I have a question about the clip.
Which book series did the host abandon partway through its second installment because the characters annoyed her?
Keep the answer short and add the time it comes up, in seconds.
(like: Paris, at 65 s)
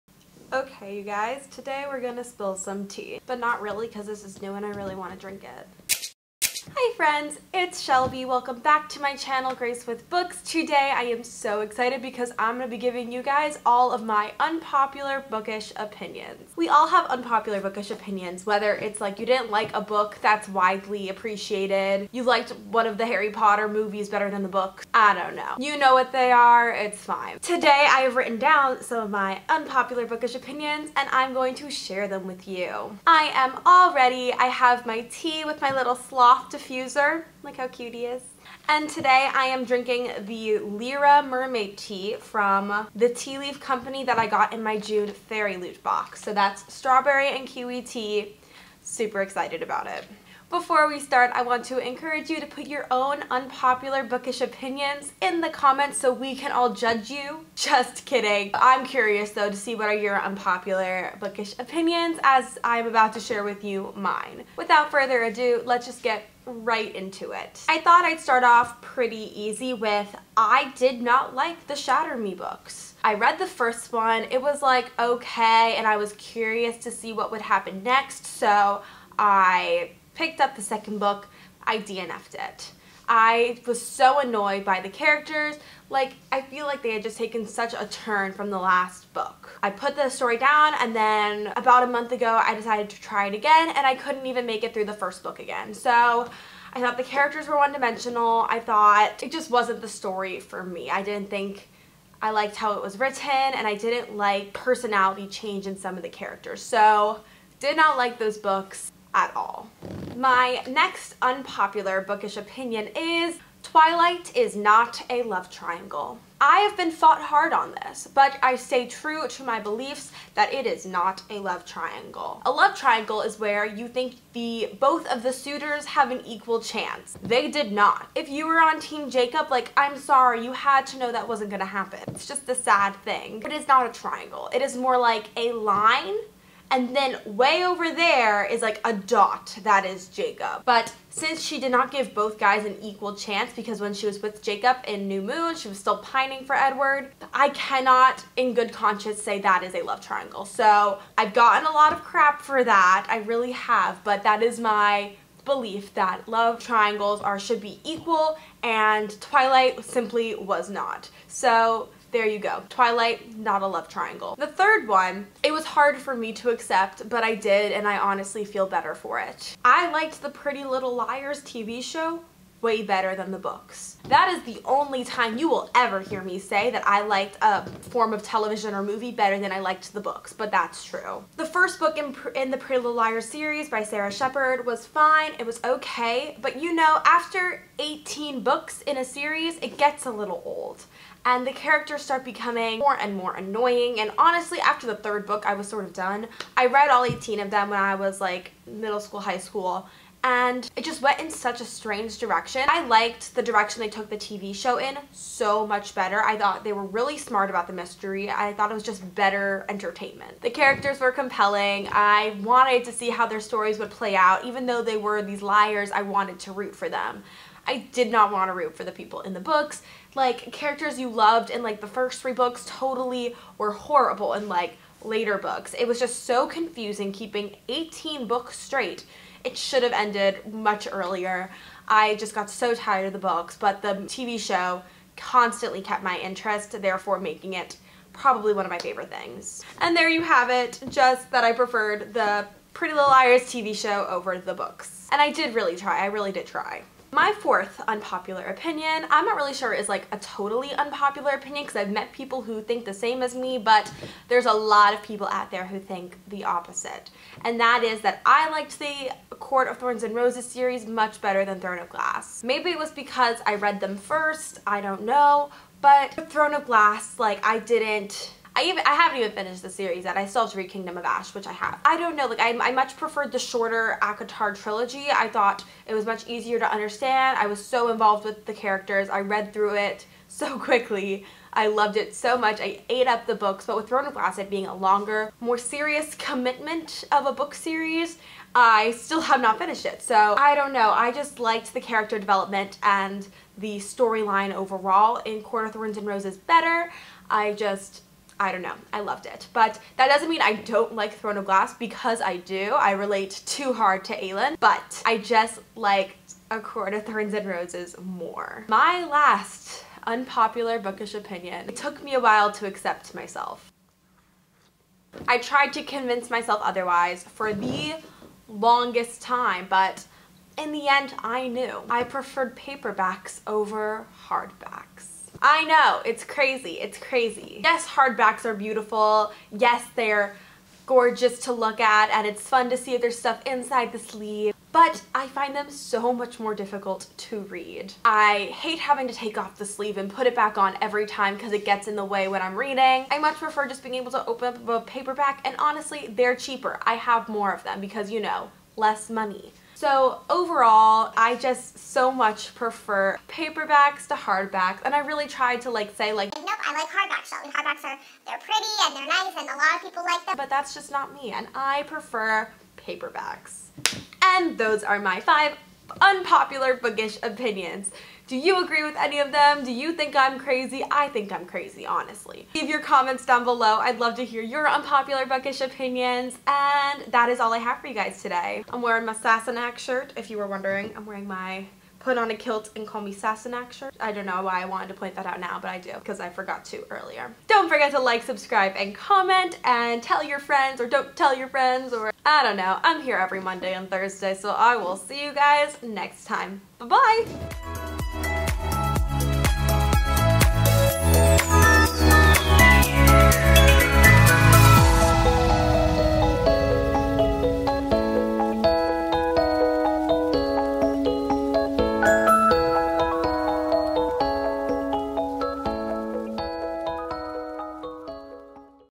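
Shatter Me, at 71 s.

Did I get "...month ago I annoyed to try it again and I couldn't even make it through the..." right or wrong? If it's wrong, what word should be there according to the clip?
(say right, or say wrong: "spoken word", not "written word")
wrong: "decided", not "annoyed".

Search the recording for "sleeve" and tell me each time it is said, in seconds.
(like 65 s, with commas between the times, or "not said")
333 s, 339 s.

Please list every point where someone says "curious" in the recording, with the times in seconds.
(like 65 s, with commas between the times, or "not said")
58 s, 76 s.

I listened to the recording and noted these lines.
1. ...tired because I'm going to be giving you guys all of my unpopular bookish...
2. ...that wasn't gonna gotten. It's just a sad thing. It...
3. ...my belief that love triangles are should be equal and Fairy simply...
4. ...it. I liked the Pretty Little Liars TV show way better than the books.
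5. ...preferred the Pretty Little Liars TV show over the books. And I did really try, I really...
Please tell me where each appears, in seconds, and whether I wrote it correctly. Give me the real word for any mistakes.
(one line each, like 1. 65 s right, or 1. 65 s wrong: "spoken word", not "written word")
1. 11 s wrong: "excited", not "tired"
2. 131 s wrong: "happen", not "gotten"
3. 154 s wrong: "Twilight", not "Fairy"
4. 169 s right
5. 241 s right.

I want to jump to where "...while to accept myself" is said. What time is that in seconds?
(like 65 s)
312 s.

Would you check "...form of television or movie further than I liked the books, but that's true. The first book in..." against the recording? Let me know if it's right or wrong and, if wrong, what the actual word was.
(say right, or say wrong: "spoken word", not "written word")
wrong: "better", not "further".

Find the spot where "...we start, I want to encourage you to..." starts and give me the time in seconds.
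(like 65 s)
50 s.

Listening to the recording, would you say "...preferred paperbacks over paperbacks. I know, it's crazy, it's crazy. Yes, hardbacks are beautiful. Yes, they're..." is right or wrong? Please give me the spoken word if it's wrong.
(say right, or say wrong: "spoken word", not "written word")
wrong: "hardbacks", not "paperbacks".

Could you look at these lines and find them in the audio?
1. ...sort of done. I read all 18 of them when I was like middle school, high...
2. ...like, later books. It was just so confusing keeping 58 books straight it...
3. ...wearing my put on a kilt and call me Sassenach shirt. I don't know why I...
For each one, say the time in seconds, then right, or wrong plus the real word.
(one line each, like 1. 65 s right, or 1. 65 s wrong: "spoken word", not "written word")
1. 195 s right
2. 224 s wrong: "18", not "58"
3. 381 s right.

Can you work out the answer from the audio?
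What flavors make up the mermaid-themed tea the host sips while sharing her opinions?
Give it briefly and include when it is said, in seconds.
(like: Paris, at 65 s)
Strawberry and kiwi, at 46 s.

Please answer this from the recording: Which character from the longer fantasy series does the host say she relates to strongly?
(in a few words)
Aelin.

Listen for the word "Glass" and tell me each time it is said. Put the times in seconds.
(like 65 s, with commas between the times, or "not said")
261 s, 266 s, 284 s, 301 s.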